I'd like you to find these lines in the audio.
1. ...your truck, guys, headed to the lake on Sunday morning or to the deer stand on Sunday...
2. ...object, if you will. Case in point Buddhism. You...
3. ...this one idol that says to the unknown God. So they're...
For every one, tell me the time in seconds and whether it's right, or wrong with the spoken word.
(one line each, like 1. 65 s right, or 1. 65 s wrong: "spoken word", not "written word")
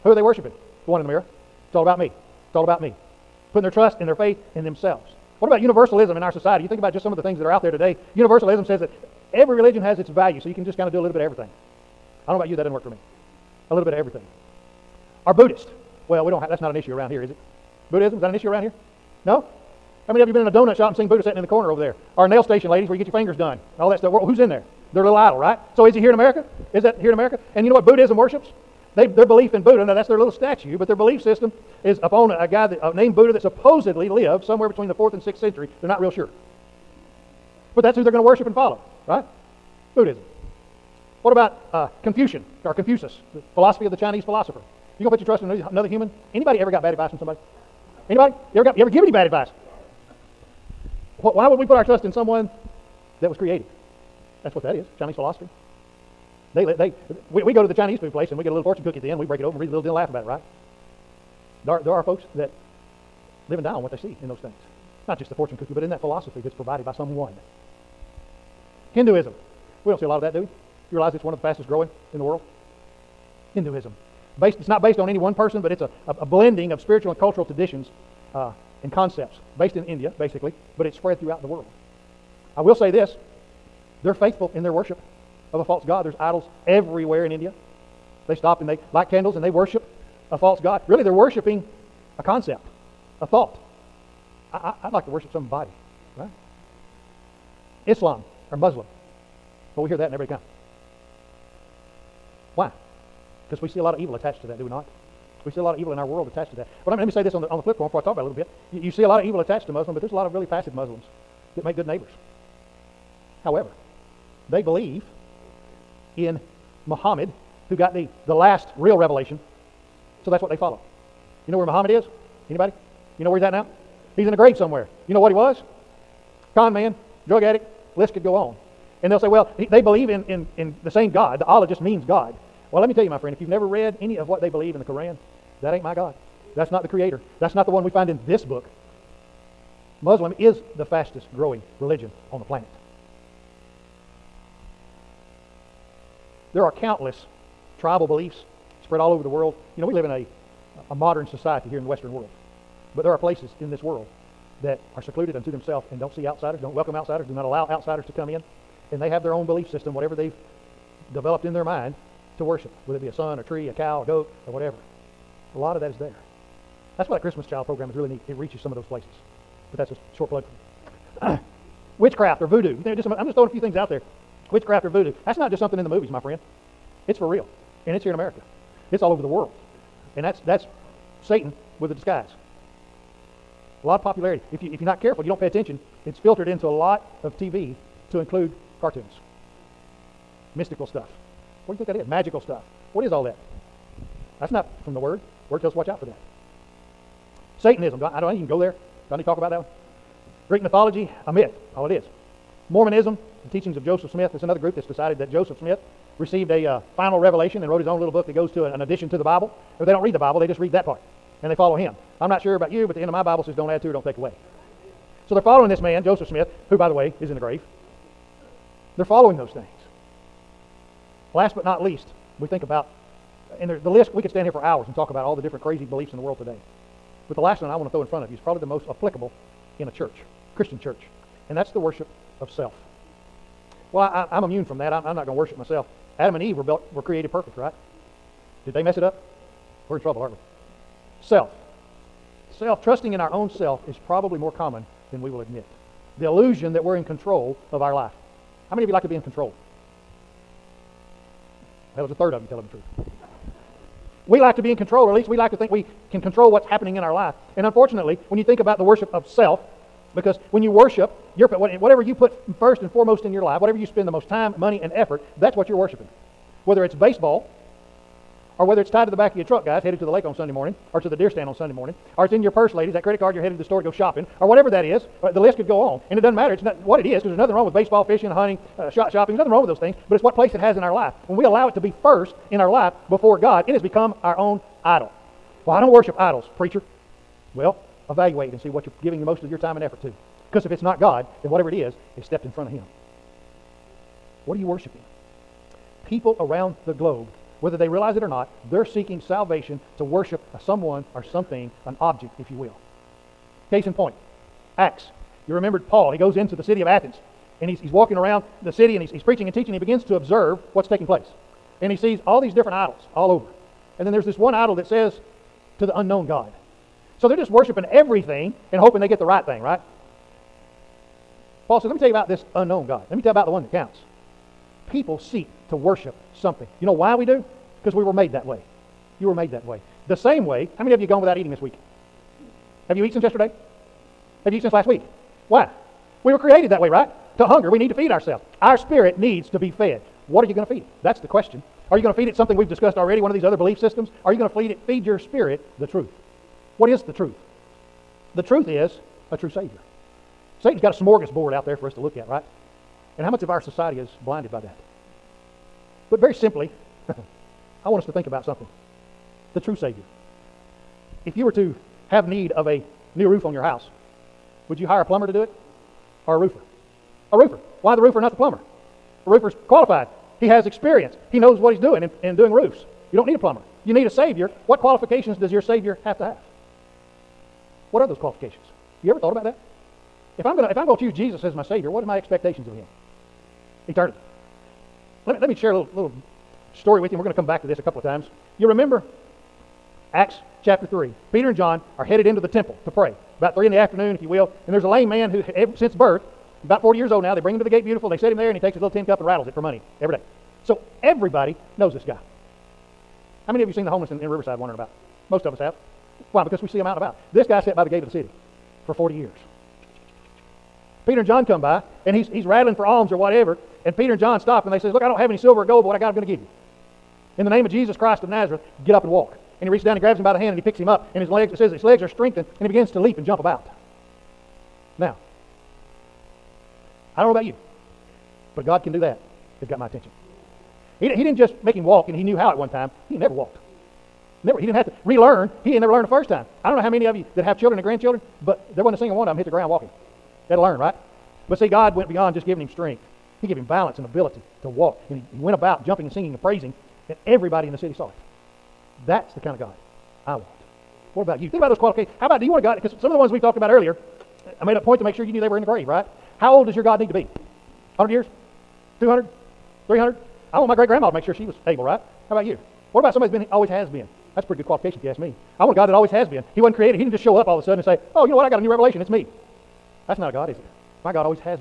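1. 269 s right
2. 302 s wrong: "Acts", not "Buddhism"
3. 314 s right.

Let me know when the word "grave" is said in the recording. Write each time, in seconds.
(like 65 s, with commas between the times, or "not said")
124 s, 217 s, 455 s.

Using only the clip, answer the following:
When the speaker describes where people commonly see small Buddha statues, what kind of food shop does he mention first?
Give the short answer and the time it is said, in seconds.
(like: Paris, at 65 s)
donut shop, at 20 s.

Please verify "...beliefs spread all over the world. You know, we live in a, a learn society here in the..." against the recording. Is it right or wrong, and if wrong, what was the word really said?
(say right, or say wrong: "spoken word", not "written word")
wrong: "modern", not "learn".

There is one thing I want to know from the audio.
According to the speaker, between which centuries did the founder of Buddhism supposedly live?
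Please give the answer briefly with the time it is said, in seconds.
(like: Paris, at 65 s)
4th and 6th, at 34 s.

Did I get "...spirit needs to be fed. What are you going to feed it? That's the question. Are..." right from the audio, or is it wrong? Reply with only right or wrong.
right.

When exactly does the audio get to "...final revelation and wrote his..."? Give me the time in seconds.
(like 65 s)
206 s.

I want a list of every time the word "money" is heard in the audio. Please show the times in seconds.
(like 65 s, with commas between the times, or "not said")
264 s, 399 s.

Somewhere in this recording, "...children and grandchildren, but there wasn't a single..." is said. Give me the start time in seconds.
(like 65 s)
437 s.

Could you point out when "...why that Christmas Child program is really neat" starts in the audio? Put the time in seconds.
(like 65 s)
167 s.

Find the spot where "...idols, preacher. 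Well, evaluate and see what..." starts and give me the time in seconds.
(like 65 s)
286 s.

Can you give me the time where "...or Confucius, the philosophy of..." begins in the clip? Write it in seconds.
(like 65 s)
42 s.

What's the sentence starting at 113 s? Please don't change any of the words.
However, they believe in Muhammad, who got the, the last real revelation.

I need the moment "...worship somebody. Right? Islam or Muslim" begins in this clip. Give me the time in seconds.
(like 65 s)
95 s.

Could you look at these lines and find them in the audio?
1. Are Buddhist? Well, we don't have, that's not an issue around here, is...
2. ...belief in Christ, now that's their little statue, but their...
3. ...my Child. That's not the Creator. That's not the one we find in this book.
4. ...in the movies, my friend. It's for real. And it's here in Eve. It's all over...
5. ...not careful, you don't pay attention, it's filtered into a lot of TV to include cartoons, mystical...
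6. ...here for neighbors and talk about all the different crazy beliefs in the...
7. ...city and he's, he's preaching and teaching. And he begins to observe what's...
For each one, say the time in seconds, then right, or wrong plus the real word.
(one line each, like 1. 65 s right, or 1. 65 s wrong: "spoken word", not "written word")
1. 15 s right
2. 29 s wrong: "Buddha", not "Christ"
3. 135 s wrong: "God", not "Child"
4. 175 s wrong: "America", not "Eve"
5. 184 s right
6. 224 s wrong: "hours", not "neighbors"
7. 308 s right.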